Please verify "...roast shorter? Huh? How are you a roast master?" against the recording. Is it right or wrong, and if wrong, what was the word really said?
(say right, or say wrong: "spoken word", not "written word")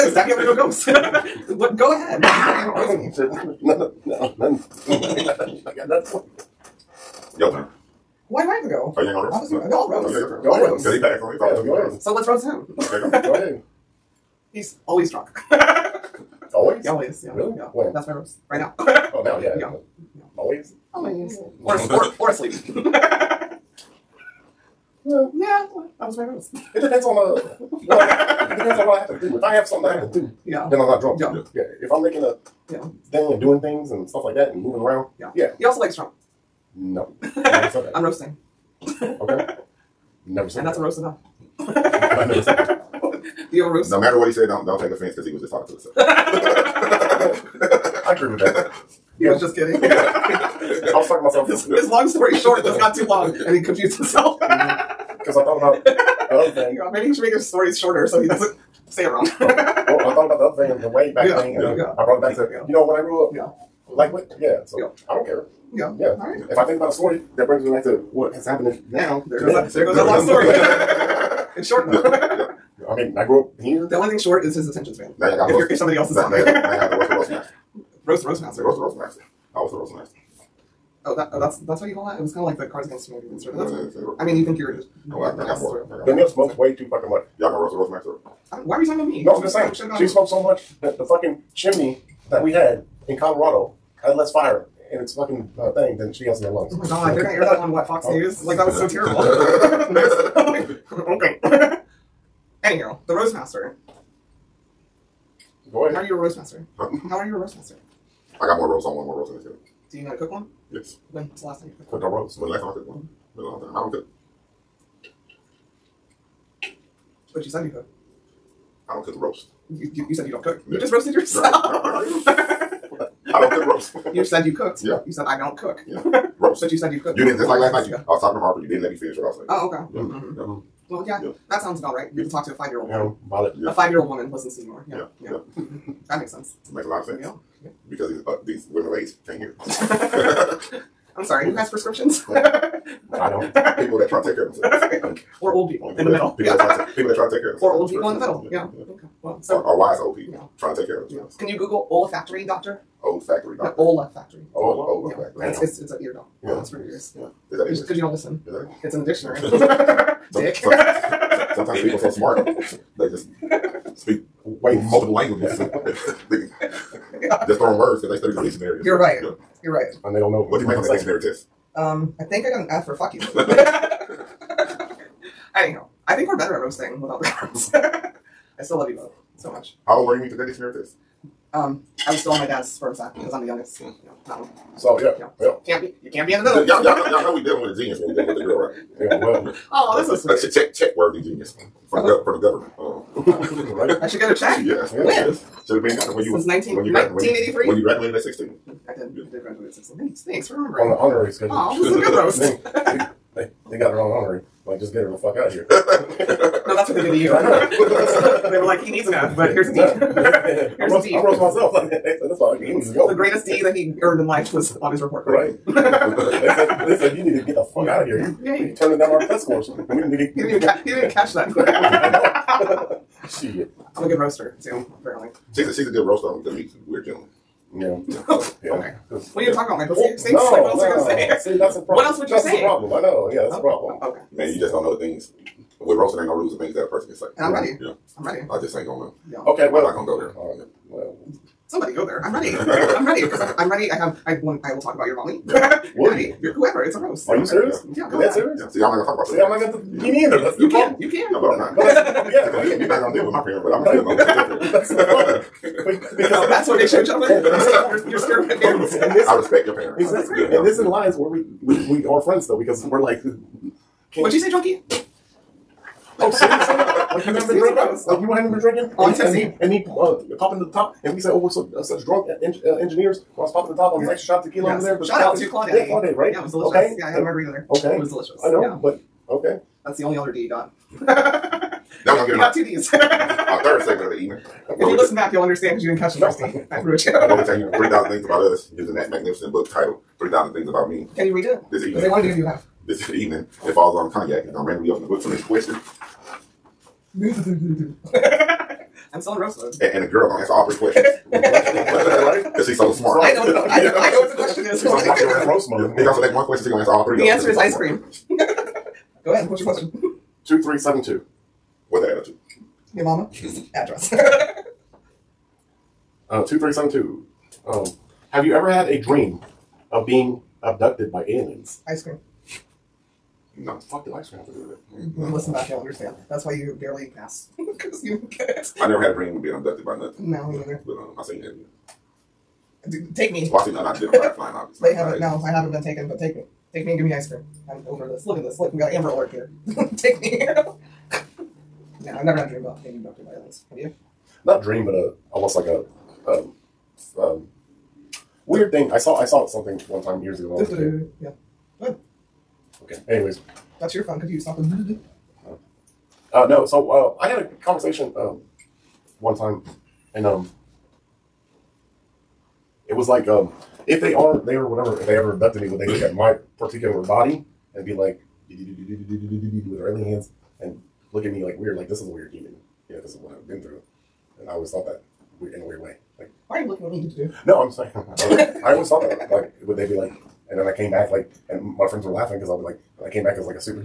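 wrong: "master", not "shorter".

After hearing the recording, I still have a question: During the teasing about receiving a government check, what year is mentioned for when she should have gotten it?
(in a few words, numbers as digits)
1983.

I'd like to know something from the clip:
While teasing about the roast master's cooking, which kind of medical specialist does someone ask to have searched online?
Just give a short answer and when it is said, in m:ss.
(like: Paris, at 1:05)
olfactory doctor, at 2:31.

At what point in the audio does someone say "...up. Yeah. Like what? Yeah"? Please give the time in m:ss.
1:03.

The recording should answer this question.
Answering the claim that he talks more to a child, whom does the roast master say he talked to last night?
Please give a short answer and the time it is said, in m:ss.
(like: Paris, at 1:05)
Harper, at 2:08.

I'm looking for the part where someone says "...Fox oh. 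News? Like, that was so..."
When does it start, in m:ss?
1:37.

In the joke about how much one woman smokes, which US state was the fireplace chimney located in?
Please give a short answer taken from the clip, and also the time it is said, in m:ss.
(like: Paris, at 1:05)
Colorado, at 1:33.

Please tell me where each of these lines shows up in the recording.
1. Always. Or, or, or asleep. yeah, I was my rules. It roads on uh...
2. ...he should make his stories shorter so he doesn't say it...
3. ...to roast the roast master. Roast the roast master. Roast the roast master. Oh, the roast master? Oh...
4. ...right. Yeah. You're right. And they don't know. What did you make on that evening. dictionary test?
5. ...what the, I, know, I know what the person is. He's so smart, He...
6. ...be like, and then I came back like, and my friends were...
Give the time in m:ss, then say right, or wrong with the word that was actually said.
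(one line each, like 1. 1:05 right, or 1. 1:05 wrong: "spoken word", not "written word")
1. 0:20 wrong: "depends", not "roads"
2. 0:57 right
3. 1:16 right
4. 2:48 wrong: "saying", not "evening"
5. 5:03 wrong: "question", not "person"
6. 6:19 right.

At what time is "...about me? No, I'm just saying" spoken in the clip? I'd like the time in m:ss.
1:28.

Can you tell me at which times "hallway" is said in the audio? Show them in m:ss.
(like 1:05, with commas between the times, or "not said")
not said.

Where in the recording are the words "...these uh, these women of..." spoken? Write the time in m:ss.
2:18.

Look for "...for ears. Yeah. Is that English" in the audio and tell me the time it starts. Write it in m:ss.
2:36.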